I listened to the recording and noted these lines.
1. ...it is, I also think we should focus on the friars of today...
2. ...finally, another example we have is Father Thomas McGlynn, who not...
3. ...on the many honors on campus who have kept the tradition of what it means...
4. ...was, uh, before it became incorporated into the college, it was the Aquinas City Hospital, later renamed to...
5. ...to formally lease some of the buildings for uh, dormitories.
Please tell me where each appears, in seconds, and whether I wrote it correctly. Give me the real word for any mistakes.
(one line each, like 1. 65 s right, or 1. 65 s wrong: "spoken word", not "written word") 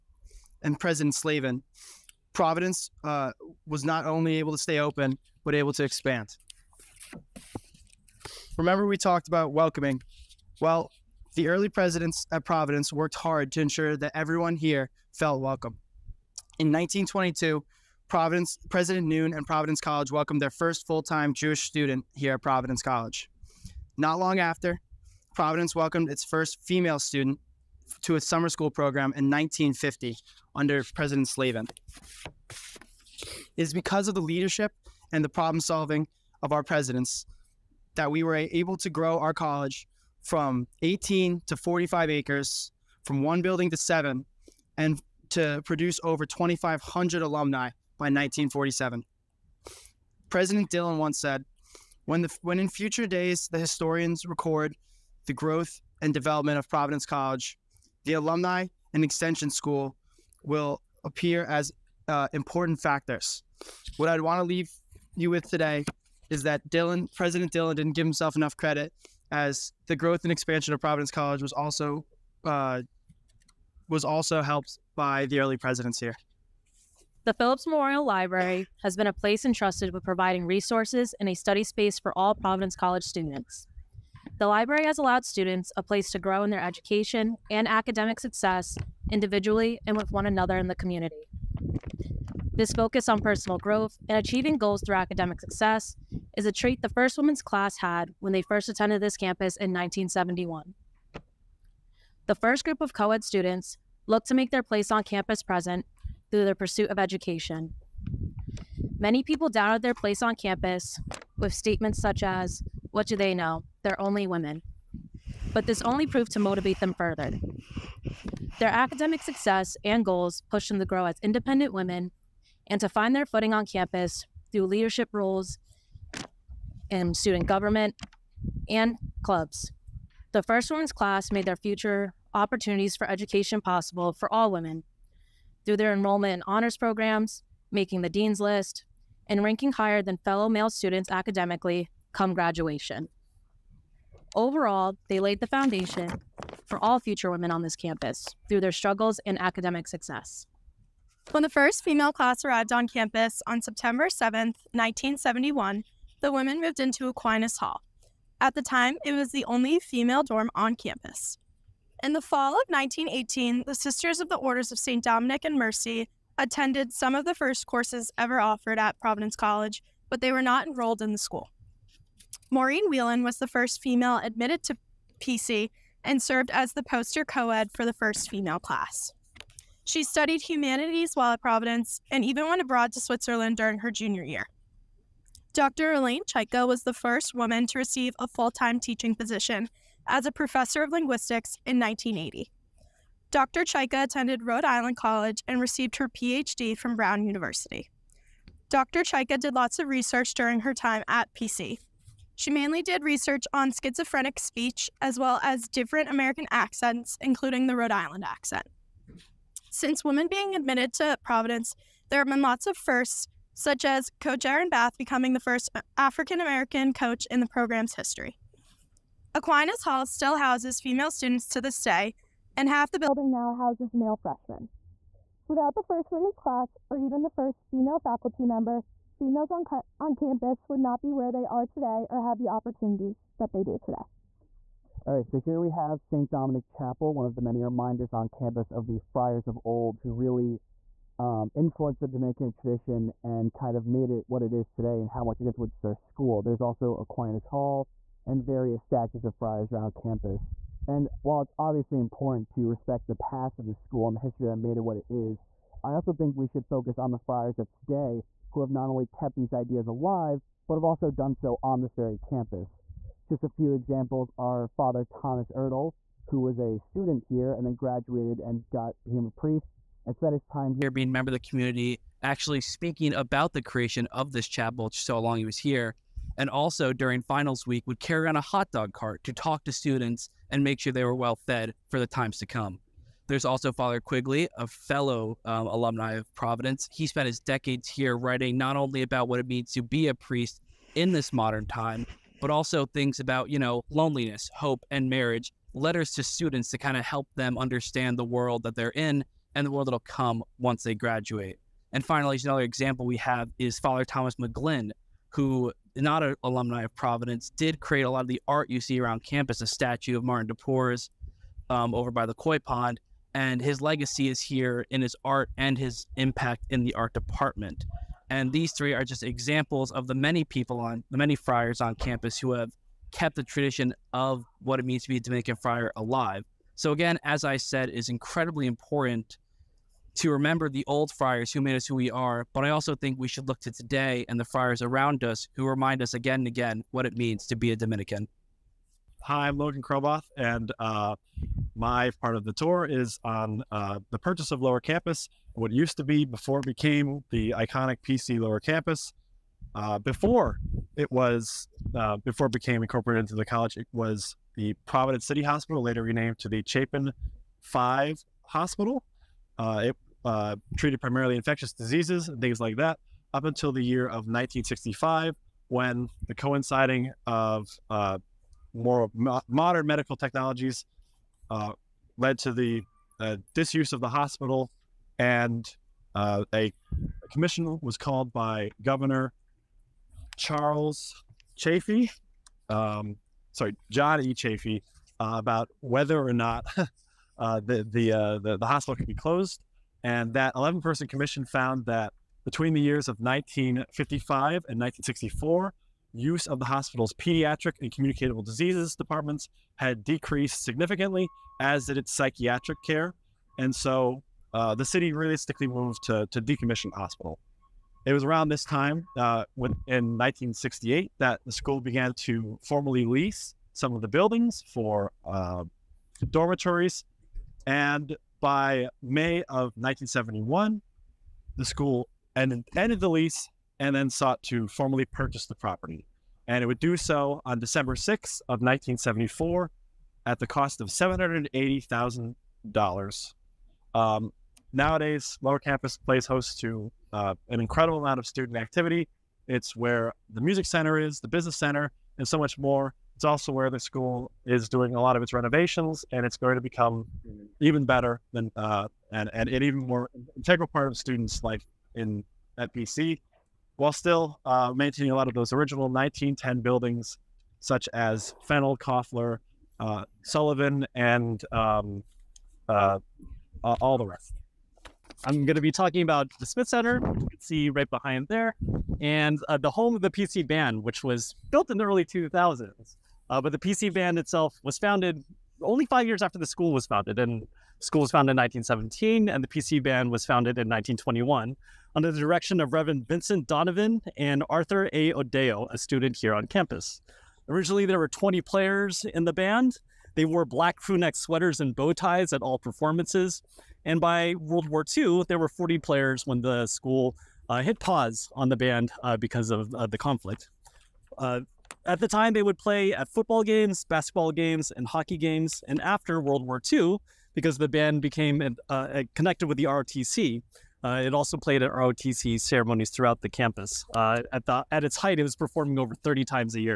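1. 254 s right
2. 302 s right
3. 320 s wrong: "friars", not "honors"
4. 351 s wrong: "Providence", not "Aquinas"
5. 412 s right.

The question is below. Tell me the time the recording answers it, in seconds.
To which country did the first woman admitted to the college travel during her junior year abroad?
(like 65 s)
183 s.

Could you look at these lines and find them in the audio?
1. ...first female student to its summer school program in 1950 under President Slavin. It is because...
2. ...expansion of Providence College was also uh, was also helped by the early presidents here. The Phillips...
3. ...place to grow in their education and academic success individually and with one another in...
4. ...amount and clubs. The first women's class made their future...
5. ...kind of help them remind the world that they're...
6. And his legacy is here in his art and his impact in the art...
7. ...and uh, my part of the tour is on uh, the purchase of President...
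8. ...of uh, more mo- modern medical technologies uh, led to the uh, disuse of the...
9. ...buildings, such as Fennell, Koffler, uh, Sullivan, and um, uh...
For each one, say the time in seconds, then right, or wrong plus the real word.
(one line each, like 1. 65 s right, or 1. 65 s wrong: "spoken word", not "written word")
1. 26 s right
2. 70 s right
3. 85 s right
4. 127 s wrong: "government", not "amount"
5. 296 s wrong: "understand", not "remind"
6. 313 s right
7. 340 s wrong: "Lower", not "President"
8. 367 s right
9. 456 s right.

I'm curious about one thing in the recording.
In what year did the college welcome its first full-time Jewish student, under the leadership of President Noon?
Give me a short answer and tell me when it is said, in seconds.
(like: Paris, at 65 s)
1922, at 16 s.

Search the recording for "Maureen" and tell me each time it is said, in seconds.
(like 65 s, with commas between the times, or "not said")
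172 s.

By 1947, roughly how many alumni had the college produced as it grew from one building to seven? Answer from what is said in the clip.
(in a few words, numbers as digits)
2,500.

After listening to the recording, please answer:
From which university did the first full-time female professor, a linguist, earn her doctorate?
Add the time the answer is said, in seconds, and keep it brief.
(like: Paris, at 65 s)
Brown University, at 196 s.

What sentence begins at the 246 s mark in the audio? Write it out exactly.
There's also Aquinas Hall, and various statues of friars around campus.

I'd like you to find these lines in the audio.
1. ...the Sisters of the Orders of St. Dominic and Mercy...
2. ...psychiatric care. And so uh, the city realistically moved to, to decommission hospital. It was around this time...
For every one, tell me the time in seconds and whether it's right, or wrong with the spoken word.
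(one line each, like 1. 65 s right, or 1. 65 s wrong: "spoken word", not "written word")
1. 163 s right
2. 402 s right.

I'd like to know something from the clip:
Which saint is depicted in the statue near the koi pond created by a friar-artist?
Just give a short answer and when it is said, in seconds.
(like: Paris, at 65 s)
Martin de Porres, at 310 s.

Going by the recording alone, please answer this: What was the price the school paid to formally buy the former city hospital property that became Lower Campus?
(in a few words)
$780,000.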